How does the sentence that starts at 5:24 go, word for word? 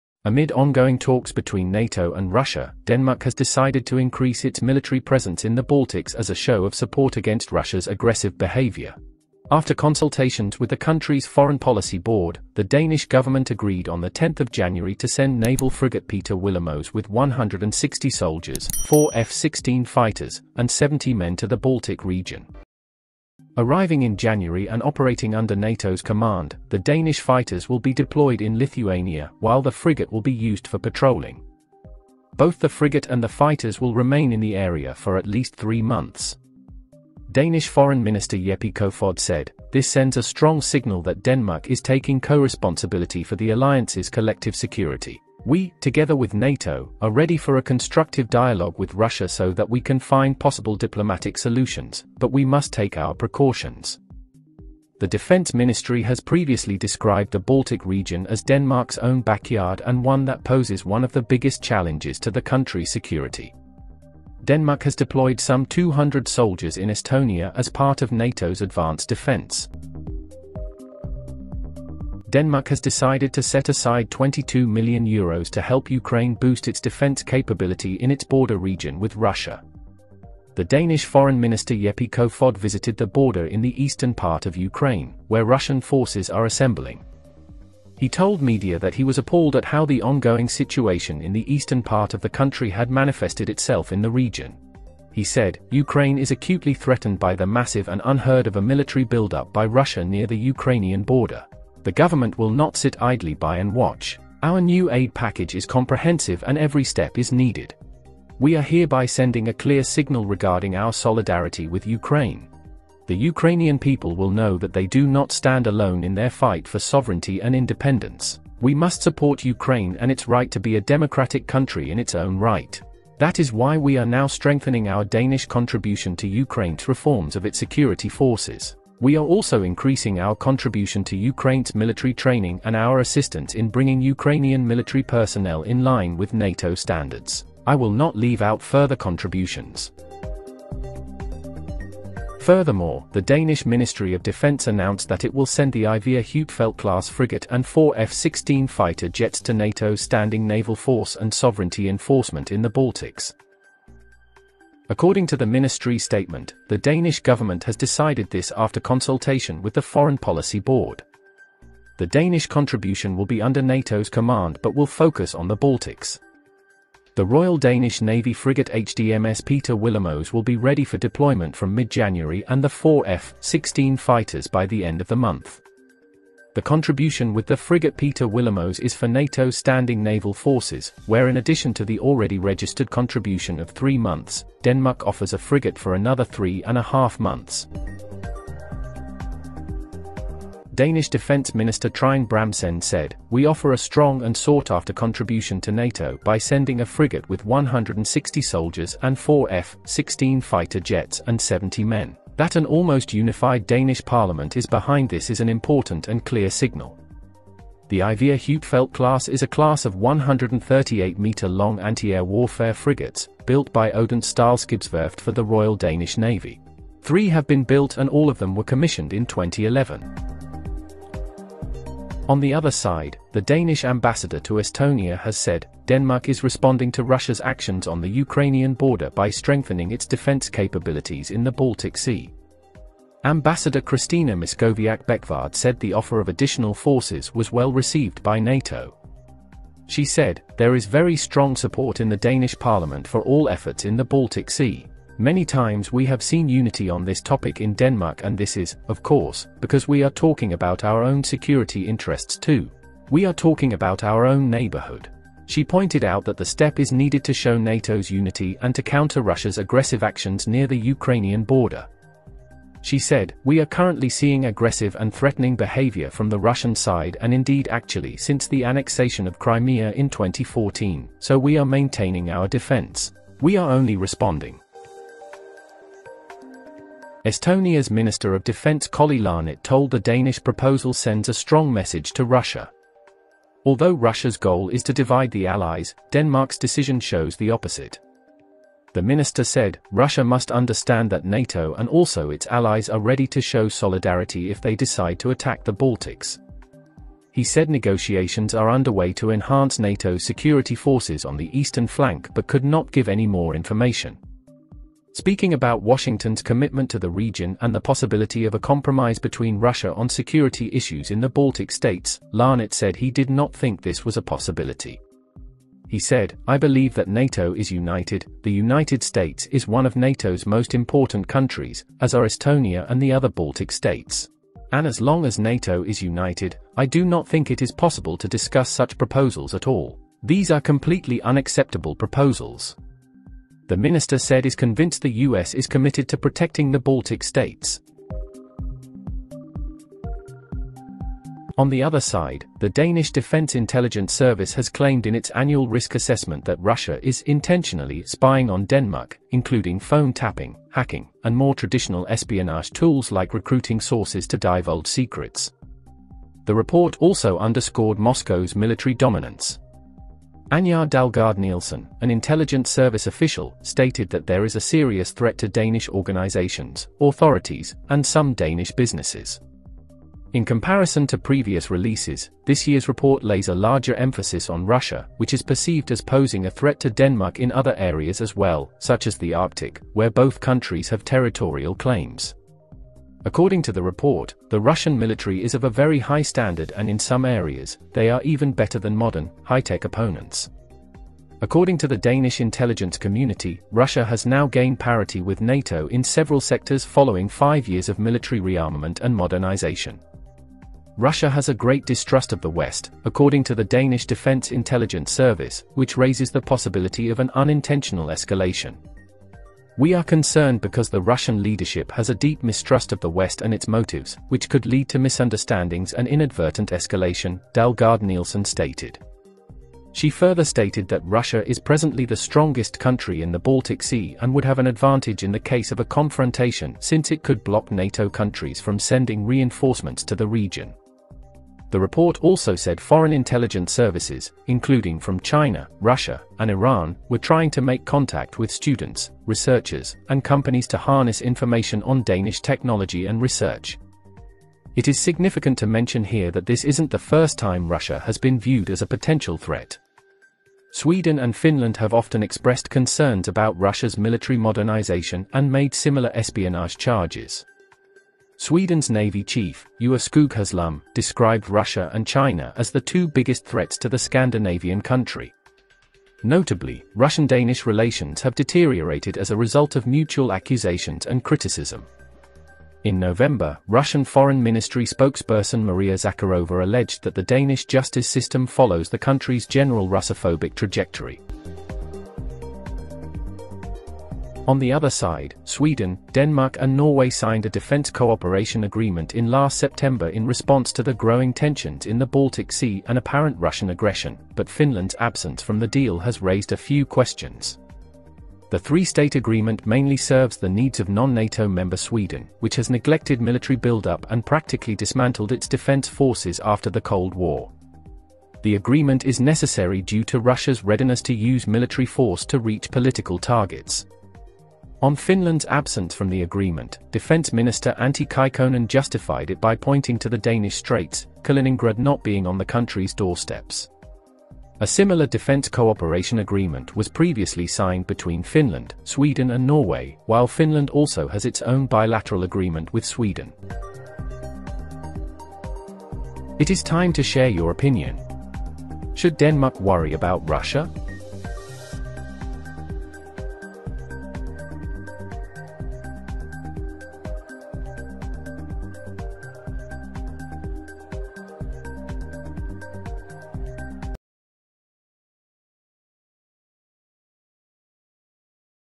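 And as long as NATO is united, I do not think it is possible to discuss such proposals at all.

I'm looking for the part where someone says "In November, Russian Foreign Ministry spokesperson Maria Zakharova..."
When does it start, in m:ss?
7:52.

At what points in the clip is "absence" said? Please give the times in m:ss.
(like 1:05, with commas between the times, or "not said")
8:14, 8:35.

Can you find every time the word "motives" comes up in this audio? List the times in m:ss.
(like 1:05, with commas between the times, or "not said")
6:53.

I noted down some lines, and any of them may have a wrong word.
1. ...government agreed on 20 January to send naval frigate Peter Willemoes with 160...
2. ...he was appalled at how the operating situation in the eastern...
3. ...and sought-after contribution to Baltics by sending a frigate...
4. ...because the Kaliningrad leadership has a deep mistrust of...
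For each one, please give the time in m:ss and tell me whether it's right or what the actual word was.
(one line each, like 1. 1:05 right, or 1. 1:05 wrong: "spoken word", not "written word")
1. 0:13 wrong: "10", not "20"
2. 1:28 wrong: "ongoing", not "operating"
3. 3:14 wrong: "NATO", not "Baltics"
4. 6:50 wrong: "Russian", not "Kaliningrad".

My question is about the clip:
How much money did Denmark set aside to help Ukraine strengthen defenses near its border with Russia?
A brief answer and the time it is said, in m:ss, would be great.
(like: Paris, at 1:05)
22 million euros, at 1:14.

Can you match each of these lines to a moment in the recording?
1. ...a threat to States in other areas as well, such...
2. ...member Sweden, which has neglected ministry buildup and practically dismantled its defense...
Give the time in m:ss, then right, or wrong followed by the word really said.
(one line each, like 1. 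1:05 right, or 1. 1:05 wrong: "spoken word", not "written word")
1. 6:16 wrong: "Denmark", not "States"
2. 8:21 wrong: "military", not "ministry".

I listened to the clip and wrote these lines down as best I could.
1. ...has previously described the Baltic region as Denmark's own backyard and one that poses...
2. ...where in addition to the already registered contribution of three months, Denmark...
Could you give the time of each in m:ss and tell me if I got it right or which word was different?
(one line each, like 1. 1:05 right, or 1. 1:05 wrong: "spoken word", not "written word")
1. 0:56 right
2. 3:01 right.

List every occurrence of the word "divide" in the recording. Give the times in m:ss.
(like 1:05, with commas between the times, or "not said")
4:44.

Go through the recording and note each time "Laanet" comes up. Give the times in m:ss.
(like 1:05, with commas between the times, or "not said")
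4:39, 5:12.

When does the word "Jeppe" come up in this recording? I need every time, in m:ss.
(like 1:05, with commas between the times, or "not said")
0:38, 1:21.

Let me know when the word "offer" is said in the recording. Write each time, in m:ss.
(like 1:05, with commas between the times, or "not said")
3:05, 3:13, 3:55.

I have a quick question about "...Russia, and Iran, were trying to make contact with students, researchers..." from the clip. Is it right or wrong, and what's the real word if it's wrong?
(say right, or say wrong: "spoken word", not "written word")
right.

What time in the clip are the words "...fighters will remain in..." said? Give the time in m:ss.
0:33.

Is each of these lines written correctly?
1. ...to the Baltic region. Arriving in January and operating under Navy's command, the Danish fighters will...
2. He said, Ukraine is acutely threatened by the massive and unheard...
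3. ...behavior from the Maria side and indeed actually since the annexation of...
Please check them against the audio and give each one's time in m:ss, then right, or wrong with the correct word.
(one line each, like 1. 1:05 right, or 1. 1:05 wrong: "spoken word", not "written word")
1. 0:21 wrong: "NATO", not "Navy"
2. 1:35 right
3. 4:25 wrong: "Russian", not "Maria".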